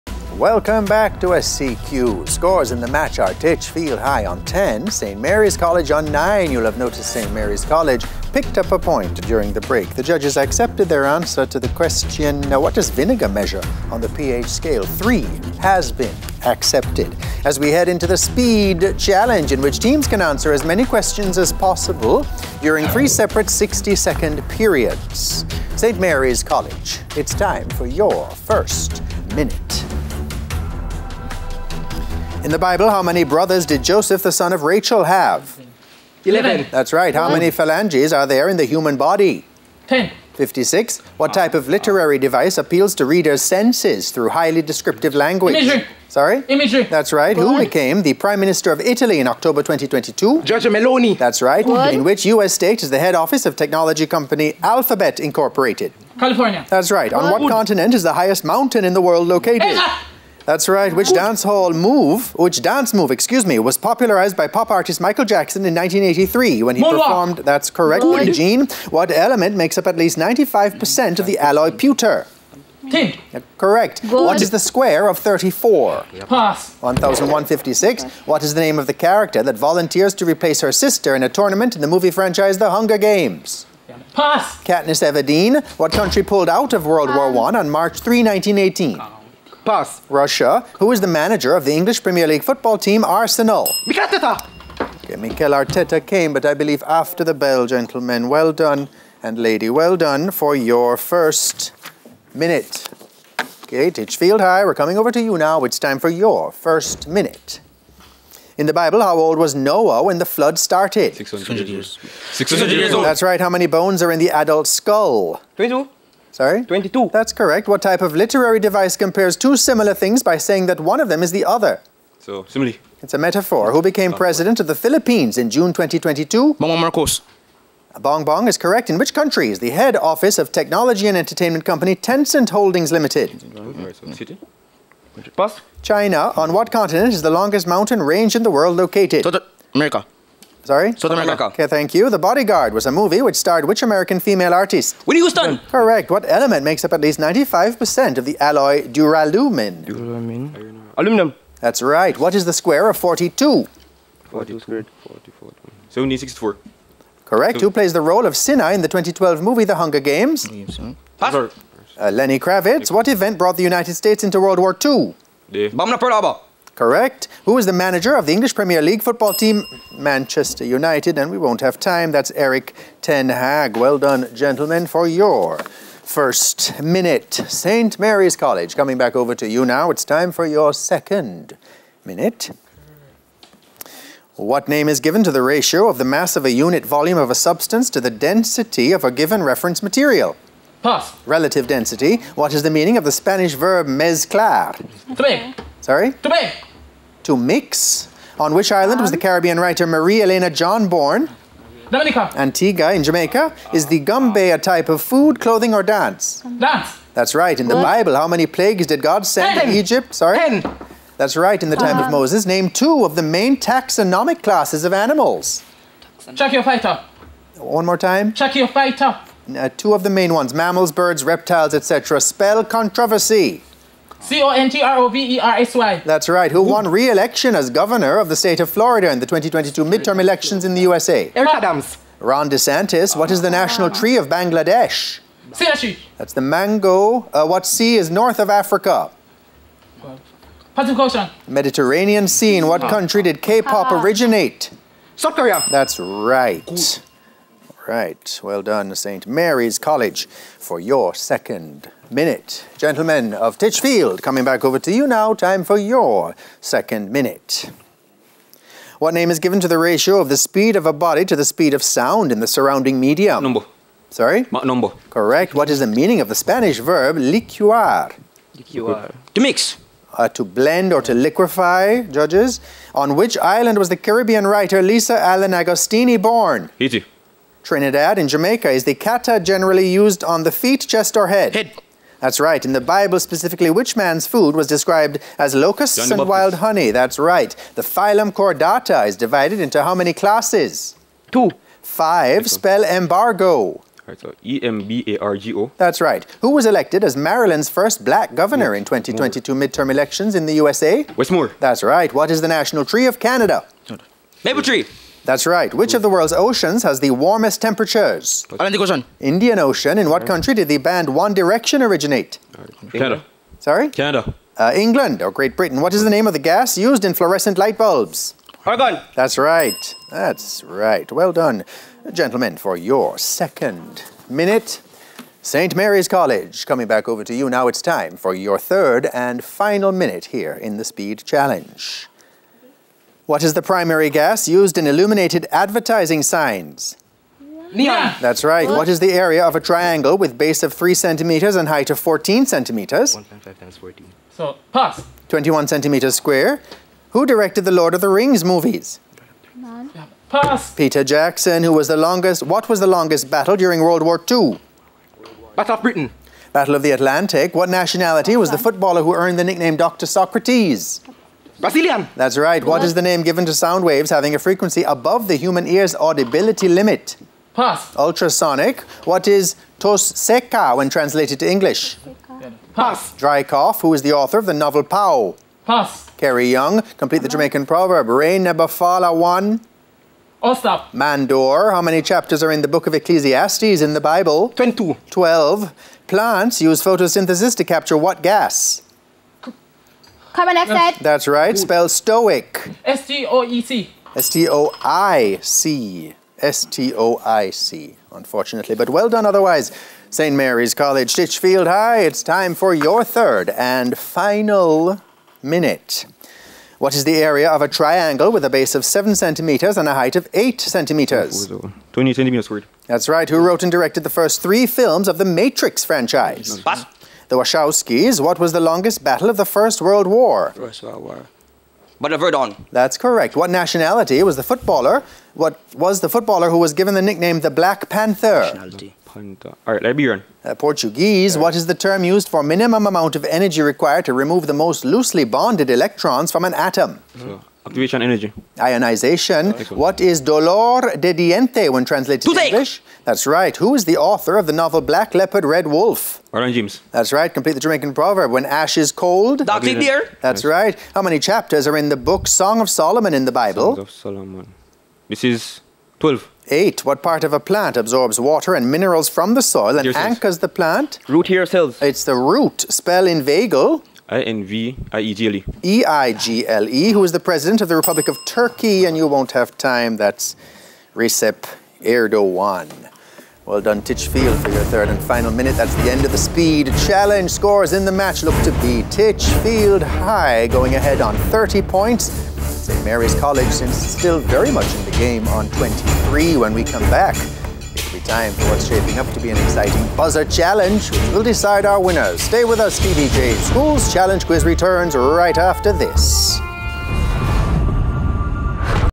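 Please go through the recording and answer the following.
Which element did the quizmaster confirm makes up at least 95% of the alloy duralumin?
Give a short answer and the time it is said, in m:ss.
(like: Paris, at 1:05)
Aluminum, at 2:30.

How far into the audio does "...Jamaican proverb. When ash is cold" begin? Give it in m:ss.
7:27.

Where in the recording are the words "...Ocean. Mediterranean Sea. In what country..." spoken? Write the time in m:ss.
4:00.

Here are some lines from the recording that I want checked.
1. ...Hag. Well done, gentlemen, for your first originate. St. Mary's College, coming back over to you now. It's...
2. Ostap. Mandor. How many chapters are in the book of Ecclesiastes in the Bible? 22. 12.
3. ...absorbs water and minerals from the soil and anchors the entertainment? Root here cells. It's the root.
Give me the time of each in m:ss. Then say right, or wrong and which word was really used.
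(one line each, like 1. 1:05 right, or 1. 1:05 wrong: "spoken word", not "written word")
1. 2:53 wrong: "minute", not "originate"
2. 6:20 right
3. 7:37 wrong: "plant", not "entertainment".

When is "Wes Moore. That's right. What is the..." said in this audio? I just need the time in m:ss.
5:01.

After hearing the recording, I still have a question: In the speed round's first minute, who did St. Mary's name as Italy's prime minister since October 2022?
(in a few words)
Giorgio Meloni.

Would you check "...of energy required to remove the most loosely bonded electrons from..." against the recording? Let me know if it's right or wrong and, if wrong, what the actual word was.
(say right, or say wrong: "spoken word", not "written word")
right.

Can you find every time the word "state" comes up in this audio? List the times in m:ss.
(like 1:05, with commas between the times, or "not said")
0:52, 2:43, 3:48.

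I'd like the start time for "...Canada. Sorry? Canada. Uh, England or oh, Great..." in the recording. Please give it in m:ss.
5:12.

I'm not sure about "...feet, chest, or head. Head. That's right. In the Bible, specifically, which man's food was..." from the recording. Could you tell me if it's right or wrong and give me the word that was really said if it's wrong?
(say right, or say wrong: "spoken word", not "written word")
right.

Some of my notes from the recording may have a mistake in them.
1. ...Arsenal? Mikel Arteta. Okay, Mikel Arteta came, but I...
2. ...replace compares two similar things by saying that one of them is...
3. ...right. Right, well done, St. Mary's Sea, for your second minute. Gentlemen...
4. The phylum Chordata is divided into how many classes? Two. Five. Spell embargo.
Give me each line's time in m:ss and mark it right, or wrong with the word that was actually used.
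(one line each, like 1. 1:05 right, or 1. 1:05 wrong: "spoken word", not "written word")
1. 1:33 right
2. 1:58 wrong: "device", not "replace"
3. 4:05 wrong: "College", not "Sea"
4. 4:47 right.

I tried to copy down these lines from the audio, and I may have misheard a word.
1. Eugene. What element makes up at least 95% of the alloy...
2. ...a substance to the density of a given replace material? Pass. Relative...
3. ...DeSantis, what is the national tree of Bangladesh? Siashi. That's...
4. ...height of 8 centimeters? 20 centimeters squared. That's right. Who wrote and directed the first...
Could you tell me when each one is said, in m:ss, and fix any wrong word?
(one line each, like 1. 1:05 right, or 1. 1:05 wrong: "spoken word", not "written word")
1. 1:08 right
2. 3:07 wrong: "reference", not "replace"
3. 3:52 right
4. 6:49 right.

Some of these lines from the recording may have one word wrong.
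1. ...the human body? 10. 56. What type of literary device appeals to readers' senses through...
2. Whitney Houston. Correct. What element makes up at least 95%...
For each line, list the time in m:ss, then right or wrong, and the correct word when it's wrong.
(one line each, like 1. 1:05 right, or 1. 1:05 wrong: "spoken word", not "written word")
1. 0:38 right
2. 2:25 right.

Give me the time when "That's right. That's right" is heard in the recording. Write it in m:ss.
5:19.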